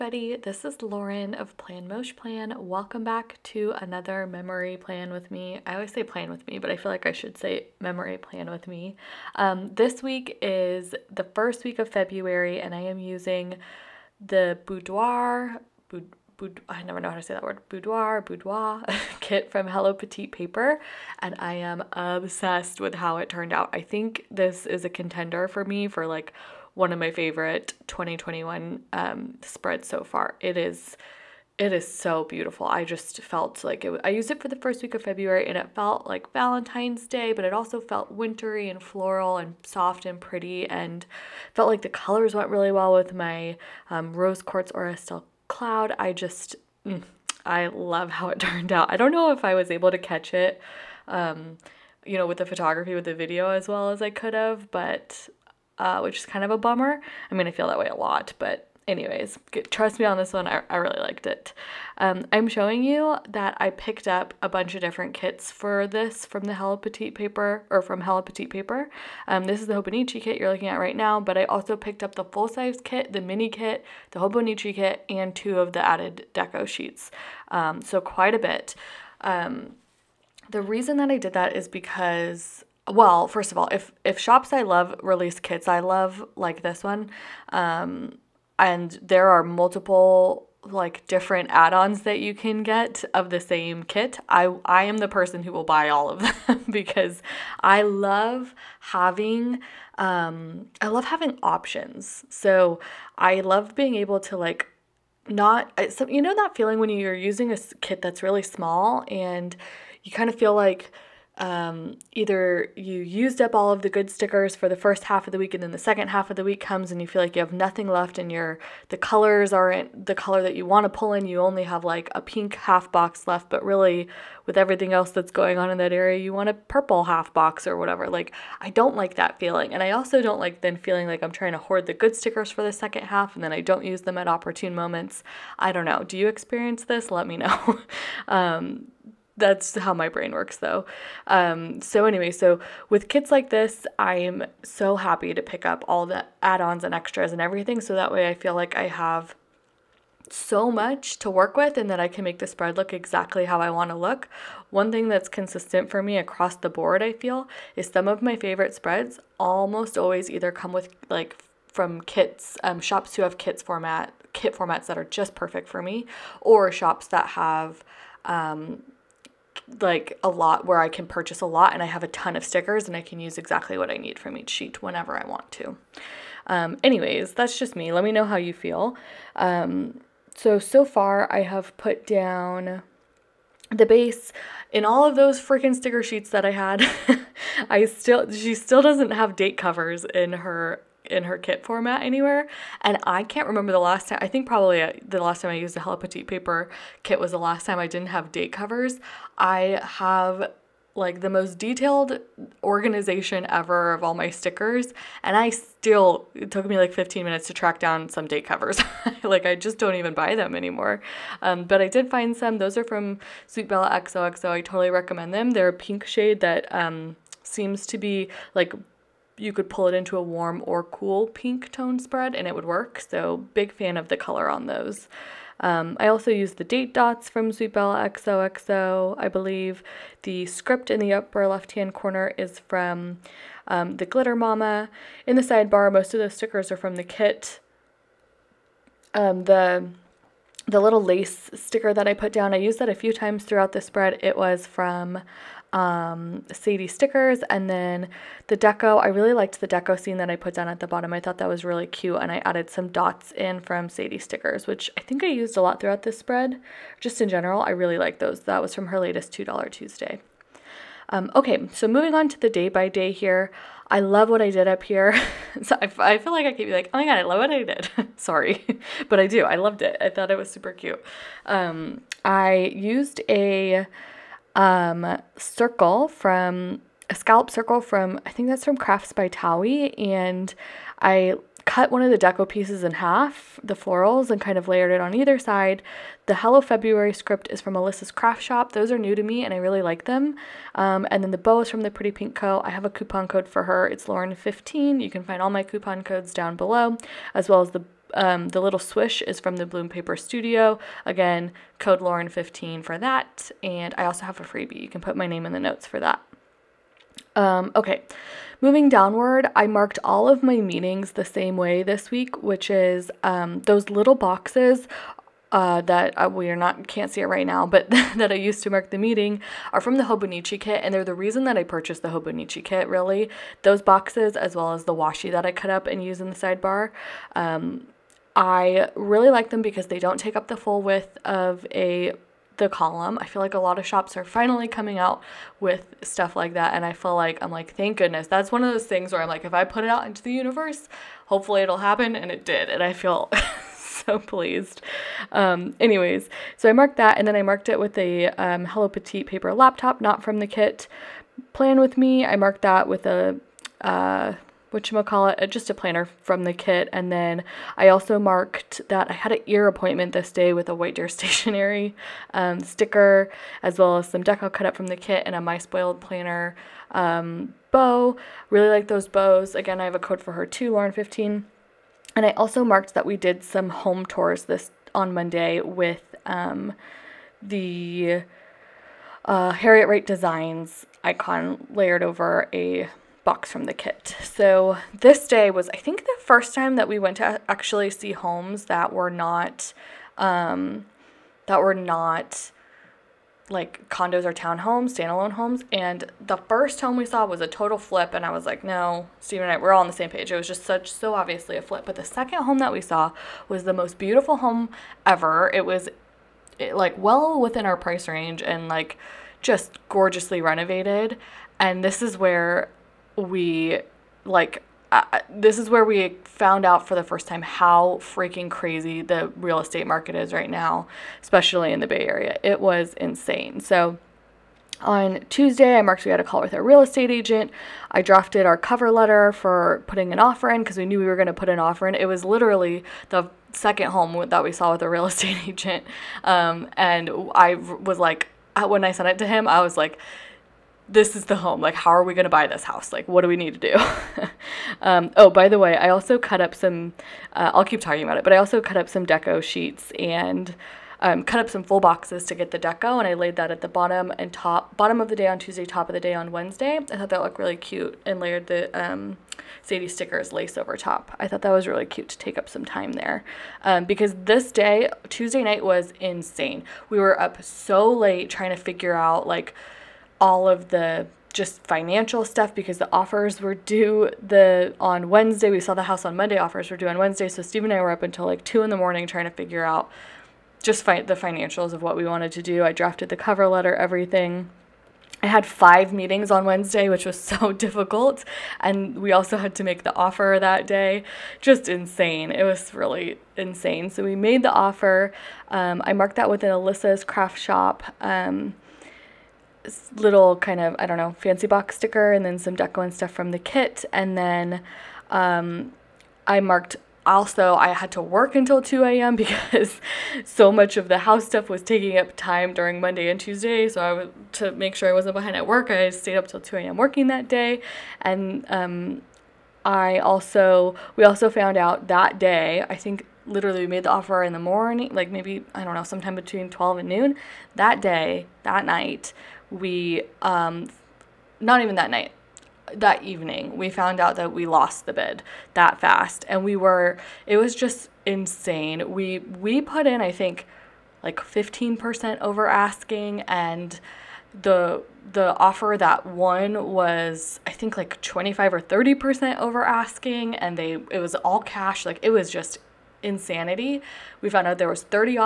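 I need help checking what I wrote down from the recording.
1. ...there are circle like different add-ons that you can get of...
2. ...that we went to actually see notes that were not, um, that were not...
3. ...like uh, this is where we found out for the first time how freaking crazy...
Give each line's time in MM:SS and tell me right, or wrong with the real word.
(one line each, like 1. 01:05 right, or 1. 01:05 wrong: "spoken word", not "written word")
1. 01:29 wrong: "multiple", not "circle"
2. 06:26 wrong: "homes", not "notes"
3. 06:54 right.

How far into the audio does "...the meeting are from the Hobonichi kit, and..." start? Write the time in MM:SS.
05:18.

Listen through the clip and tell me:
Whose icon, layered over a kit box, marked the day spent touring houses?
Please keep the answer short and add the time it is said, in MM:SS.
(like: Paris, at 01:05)
Harriet Wright Designs, at 06:19.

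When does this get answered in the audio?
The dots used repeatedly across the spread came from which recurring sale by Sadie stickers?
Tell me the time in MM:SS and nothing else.
04:19.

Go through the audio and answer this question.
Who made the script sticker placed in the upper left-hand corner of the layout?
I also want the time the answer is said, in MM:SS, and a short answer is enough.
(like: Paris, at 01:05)
The Glitter Momma, at 03:53.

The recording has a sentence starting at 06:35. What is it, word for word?
And the first home we saw was a total flip.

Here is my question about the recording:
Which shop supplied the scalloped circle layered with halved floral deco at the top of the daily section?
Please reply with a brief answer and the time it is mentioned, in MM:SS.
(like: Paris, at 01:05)
Crafts by Towie, at 04:38.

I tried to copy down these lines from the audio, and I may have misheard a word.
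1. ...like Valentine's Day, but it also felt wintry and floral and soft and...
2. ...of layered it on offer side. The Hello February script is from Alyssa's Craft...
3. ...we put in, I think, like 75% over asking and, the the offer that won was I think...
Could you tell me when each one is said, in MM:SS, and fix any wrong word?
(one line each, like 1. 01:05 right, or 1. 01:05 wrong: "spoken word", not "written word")
1. 00:36 right
2. 04:44 wrong: "either", not "offer"
3. 08:59 wrong: "15", not "75".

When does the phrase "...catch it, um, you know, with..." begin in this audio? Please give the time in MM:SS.
00:49.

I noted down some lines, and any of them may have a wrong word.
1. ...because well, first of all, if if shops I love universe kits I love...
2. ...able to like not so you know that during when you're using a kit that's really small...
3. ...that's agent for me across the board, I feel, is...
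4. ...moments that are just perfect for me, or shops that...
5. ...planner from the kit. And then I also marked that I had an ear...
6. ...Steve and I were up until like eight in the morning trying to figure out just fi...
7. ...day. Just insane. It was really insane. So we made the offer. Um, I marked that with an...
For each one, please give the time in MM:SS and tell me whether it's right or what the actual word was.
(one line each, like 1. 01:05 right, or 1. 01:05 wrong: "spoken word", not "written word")
1. 01:21 wrong: "release", not "universe"
2. 01:43 wrong: "feeling", not "during"
3. 02:35 wrong: "consistent", not "agent"
4. 02:44 wrong: "formats", not "moments"
5. 05:55 right
6. 07:57 wrong: "two", not "eight"
7. 08:10 right.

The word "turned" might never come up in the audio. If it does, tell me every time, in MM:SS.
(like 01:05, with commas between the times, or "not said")
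00:23, 00:48.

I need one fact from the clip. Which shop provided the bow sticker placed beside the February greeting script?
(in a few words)
The Pretty Pink Co.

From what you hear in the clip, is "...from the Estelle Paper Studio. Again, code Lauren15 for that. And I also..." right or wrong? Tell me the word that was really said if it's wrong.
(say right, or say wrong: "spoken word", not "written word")
wrong: "Bloom", not "Estelle".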